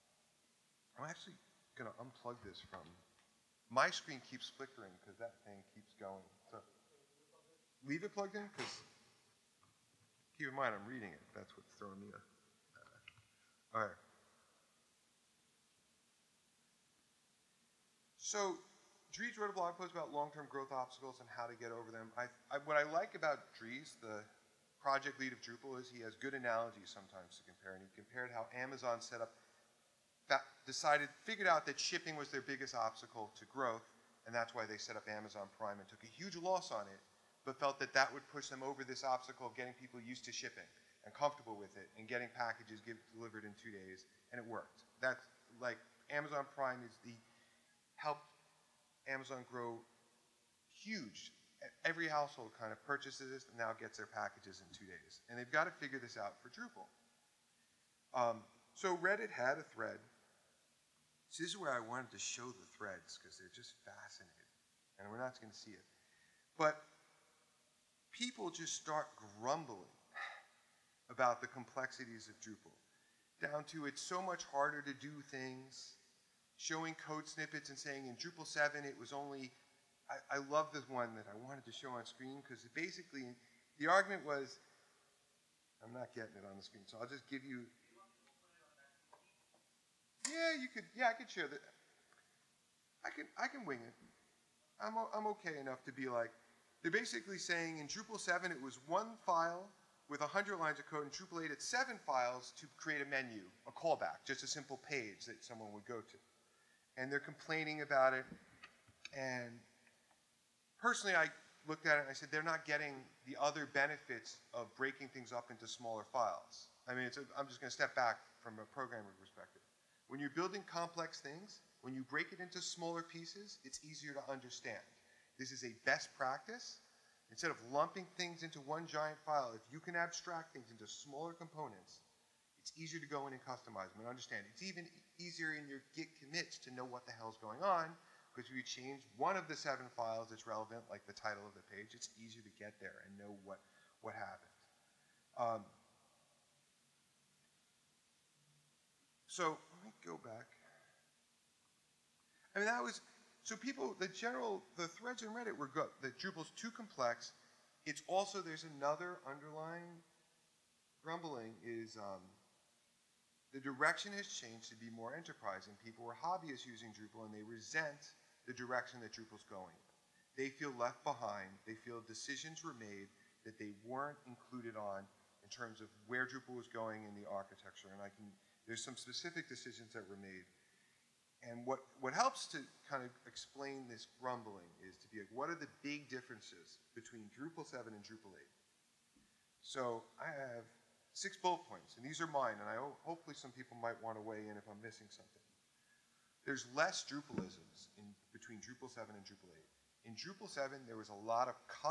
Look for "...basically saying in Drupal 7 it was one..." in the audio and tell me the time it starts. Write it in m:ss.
1:36.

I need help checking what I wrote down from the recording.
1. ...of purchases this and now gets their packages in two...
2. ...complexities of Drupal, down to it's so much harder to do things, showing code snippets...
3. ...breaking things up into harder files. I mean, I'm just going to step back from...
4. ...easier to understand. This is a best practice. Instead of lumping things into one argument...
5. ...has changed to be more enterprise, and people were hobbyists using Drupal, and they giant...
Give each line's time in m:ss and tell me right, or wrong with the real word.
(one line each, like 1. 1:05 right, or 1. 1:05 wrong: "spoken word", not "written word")
1. 0:52 right
2. 1:11 right
3. 1:54 wrong: "smaller", not "harder"
4. 2:03 wrong: "giant", not "argument"
5. 2:44 wrong: "resent", not "giant".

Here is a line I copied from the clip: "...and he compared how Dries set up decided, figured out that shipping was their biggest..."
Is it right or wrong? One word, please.
wrong.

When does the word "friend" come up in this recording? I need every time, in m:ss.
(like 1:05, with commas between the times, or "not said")
not said.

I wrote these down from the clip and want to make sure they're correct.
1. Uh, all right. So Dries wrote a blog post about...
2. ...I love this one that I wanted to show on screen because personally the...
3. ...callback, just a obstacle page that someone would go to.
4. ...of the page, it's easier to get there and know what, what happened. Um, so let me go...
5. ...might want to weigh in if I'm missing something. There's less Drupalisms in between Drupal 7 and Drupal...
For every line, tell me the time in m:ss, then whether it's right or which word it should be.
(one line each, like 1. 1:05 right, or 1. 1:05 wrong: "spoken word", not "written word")
1. 0:12 right
2. 1:20 wrong: "basically", not "personally"
3. 1:43 wrong: "simple", not "obstacle"
4. 2:21 right
5. 3:13 right.